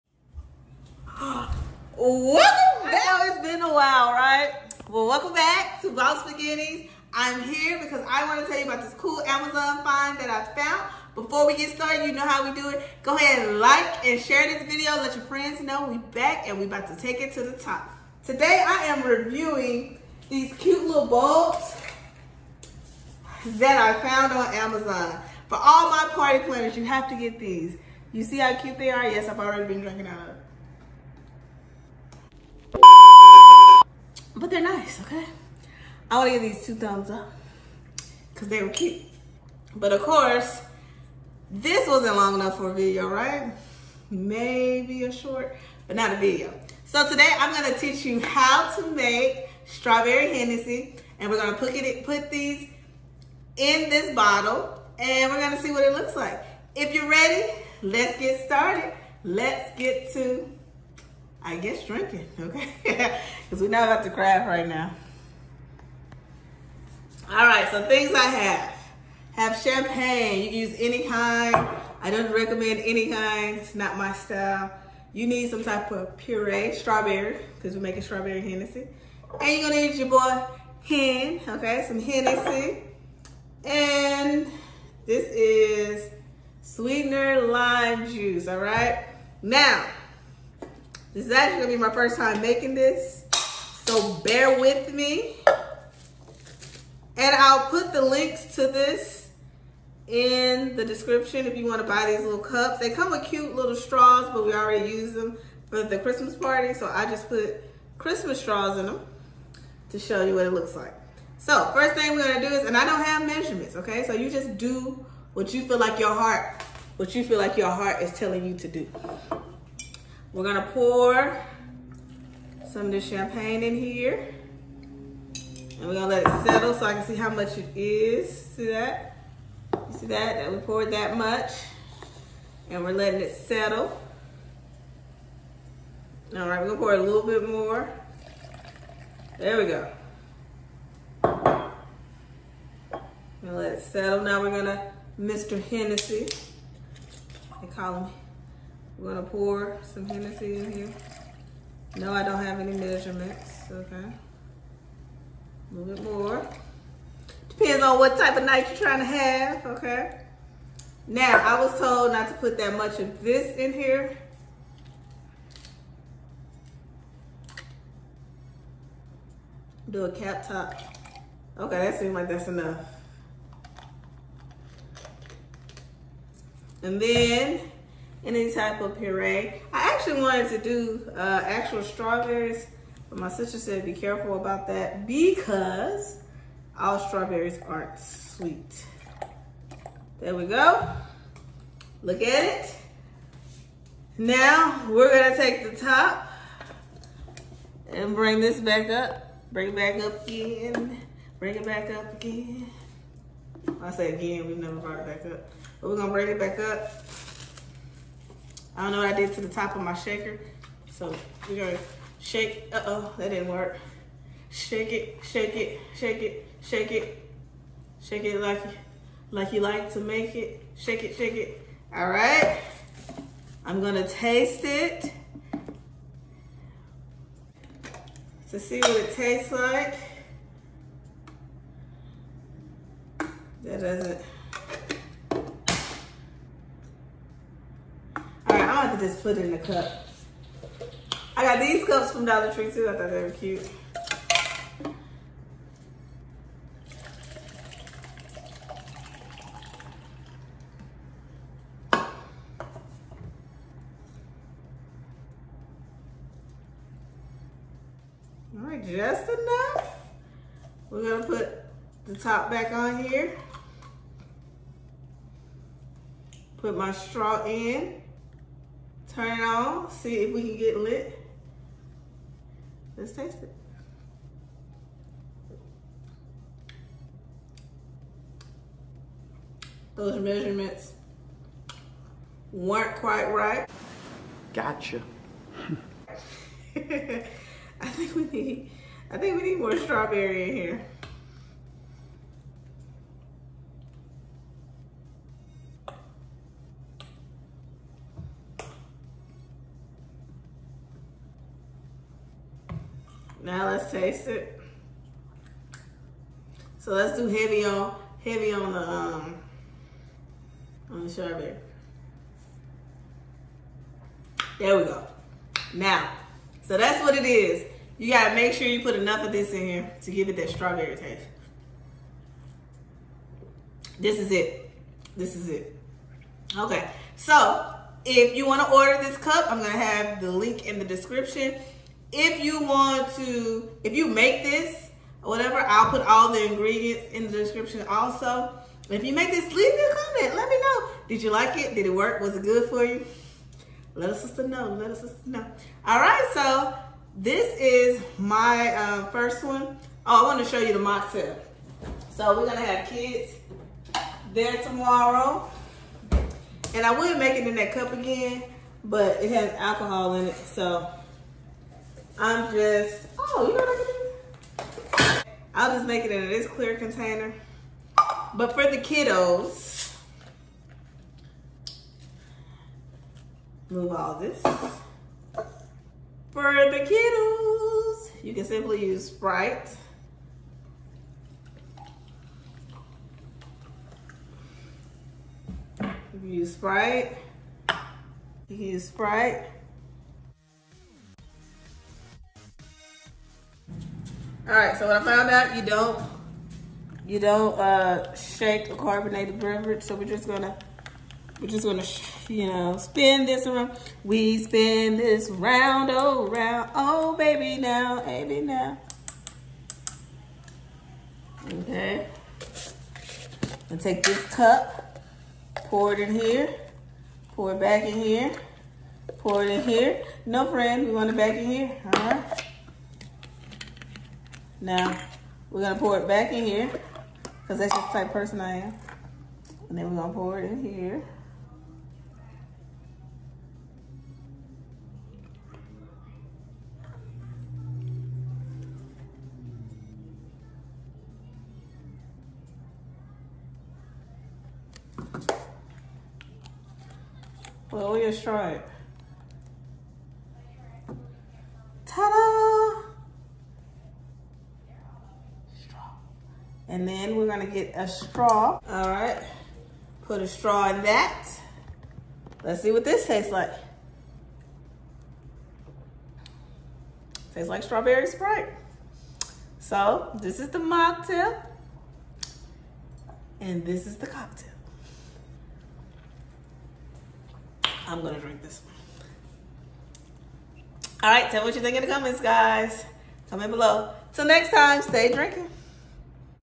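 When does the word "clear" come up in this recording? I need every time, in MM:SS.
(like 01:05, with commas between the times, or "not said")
06:06.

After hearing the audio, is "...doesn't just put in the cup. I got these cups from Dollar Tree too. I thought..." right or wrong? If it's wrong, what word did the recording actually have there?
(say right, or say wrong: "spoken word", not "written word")
right.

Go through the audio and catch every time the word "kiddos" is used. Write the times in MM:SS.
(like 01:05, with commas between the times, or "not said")
06:08, 06:16.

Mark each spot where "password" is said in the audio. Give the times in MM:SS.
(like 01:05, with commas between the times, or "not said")
not said.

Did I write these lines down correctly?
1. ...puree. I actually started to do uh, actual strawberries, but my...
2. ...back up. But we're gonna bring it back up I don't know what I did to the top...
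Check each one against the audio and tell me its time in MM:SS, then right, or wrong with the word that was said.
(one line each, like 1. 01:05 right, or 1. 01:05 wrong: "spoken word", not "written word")
1. 02:58 wrong: "wanted", not "started"
2. 03:25 right.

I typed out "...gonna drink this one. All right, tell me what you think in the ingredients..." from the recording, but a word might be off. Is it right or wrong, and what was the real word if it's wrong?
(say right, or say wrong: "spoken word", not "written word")
wrong: "comments", not "ingredients".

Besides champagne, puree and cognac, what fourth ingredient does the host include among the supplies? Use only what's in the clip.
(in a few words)
Sweetener lime juice.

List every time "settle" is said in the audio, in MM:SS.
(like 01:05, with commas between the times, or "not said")
02:06, 02:13, 02:23.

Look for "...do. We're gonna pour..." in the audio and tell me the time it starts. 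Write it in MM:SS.
01:58.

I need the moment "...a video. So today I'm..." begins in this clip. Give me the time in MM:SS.
00:46.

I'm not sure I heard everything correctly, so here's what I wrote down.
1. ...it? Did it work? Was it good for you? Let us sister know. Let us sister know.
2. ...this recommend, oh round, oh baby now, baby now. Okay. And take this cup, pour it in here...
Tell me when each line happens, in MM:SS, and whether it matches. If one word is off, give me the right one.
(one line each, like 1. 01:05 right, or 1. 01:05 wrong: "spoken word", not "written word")
1. 05:41 right
2. 06:44 wrong: "round", not "recommend".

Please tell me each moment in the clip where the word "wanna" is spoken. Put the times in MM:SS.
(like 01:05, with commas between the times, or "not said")
01:41, 05:28.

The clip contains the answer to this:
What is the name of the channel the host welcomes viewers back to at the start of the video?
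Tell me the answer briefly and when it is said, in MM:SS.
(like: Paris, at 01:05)
Boss Beginnings, at 00:05.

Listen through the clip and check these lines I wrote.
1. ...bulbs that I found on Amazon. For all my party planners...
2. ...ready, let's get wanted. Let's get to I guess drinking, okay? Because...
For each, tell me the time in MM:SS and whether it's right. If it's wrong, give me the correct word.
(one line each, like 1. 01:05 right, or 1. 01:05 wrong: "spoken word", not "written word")
1. 00:21 right
2. 00:57 wrong: "started", not "wanted".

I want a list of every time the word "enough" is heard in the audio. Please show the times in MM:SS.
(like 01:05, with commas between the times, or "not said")
00:42, 02:52, 04:19, 05:18.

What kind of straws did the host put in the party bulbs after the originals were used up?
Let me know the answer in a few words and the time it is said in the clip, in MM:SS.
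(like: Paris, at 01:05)
Christmas straws, at 01:47.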